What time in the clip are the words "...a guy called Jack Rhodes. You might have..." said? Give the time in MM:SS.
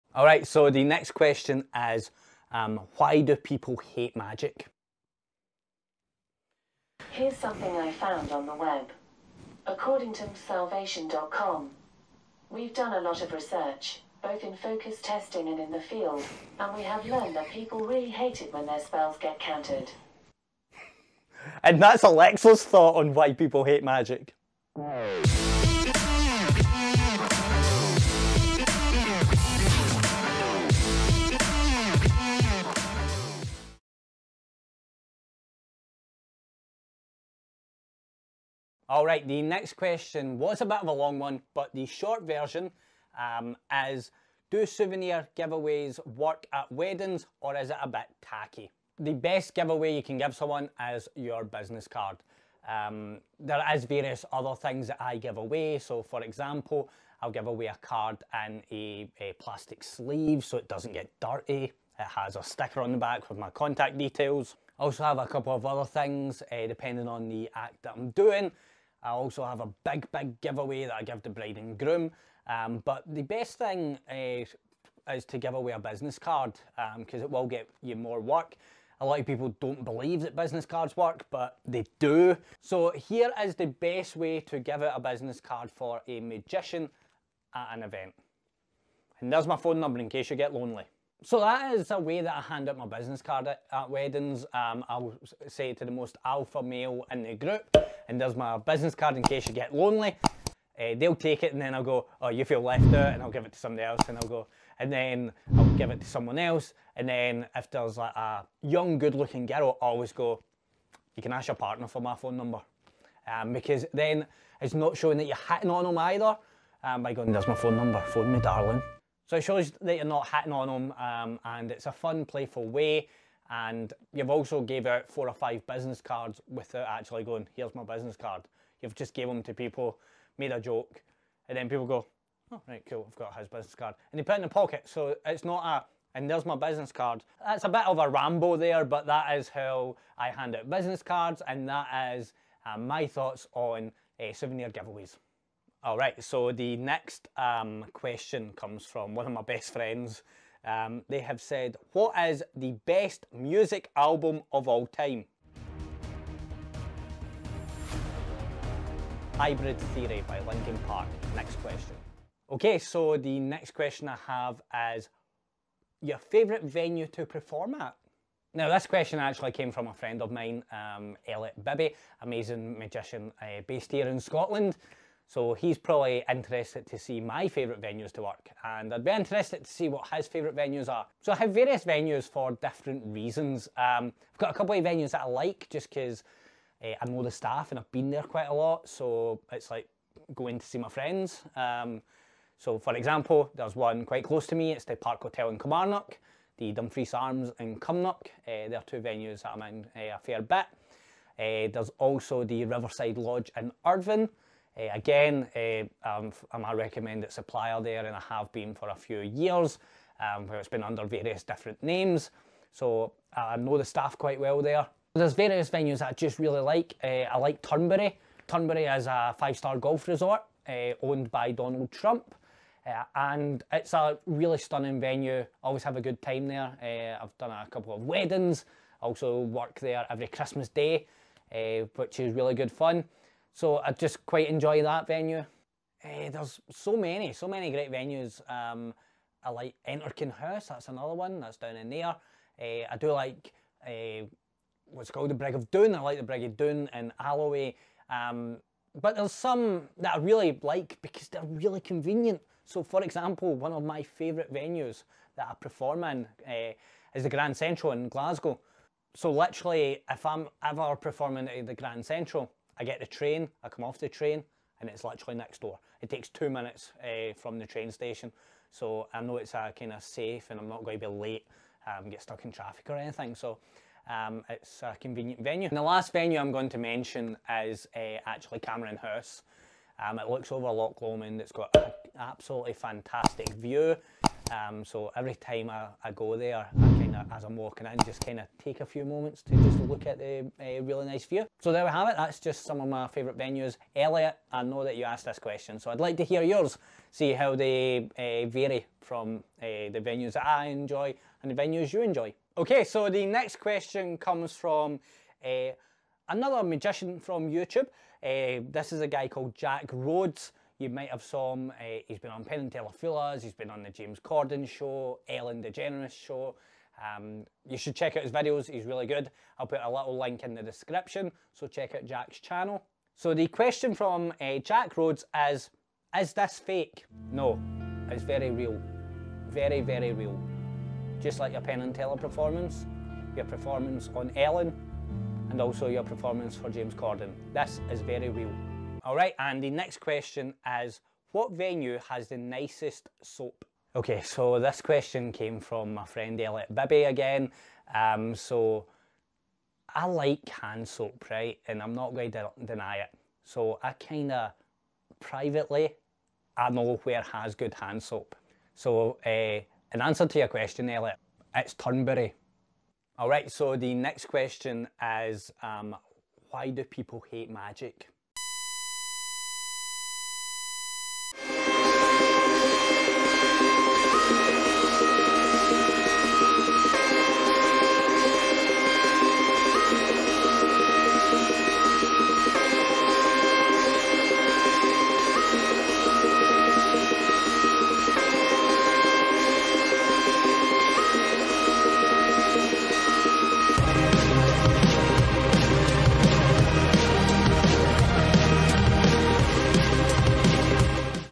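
05:09.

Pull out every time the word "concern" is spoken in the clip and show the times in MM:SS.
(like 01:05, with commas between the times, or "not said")
not said.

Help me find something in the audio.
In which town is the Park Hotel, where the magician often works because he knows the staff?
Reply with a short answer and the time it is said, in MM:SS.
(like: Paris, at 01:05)
Kilmarnock, at 03:15.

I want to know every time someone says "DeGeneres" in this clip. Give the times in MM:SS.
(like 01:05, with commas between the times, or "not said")
05:15.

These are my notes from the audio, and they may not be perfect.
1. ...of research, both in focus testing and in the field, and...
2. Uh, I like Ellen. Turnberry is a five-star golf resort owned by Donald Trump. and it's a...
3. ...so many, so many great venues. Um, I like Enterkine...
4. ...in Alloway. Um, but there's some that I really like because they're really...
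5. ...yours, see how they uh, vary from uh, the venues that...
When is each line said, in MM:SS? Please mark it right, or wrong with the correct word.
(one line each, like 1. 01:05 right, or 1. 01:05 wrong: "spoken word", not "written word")
1. 00:13 right
2. 03:37 wrong: "Turnberry", not "Ellen"
3. 03:56 right
4. 04:06 right
5. 04:56 right.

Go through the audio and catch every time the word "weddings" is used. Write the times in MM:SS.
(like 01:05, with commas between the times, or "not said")
00:46, 01:33, 03:48.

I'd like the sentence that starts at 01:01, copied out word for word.
It has a sticker on the back with my contact details.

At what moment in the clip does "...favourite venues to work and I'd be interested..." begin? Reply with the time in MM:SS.
02:57.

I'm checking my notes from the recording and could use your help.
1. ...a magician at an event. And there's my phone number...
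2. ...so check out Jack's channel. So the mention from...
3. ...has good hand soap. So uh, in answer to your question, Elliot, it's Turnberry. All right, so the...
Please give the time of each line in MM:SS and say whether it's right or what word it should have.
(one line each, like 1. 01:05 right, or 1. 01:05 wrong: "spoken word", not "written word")
1. 01:26 right
2. 05:21 wrong: "question", not "mention"
3. 05:57 right.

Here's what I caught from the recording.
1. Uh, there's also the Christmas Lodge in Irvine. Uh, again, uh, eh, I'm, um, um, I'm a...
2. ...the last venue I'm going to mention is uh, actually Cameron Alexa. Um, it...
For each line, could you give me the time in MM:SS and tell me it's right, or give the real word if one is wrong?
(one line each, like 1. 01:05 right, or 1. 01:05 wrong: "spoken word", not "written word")
1. 03:21 wrong: "Riverside", not "Christmas"
2. 04:35 wrong: "House", not "Alexa".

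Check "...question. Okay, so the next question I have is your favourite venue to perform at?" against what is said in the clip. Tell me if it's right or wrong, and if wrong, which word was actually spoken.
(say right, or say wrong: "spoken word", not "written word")
right.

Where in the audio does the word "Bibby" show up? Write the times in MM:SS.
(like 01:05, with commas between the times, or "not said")
02:51, 05:46.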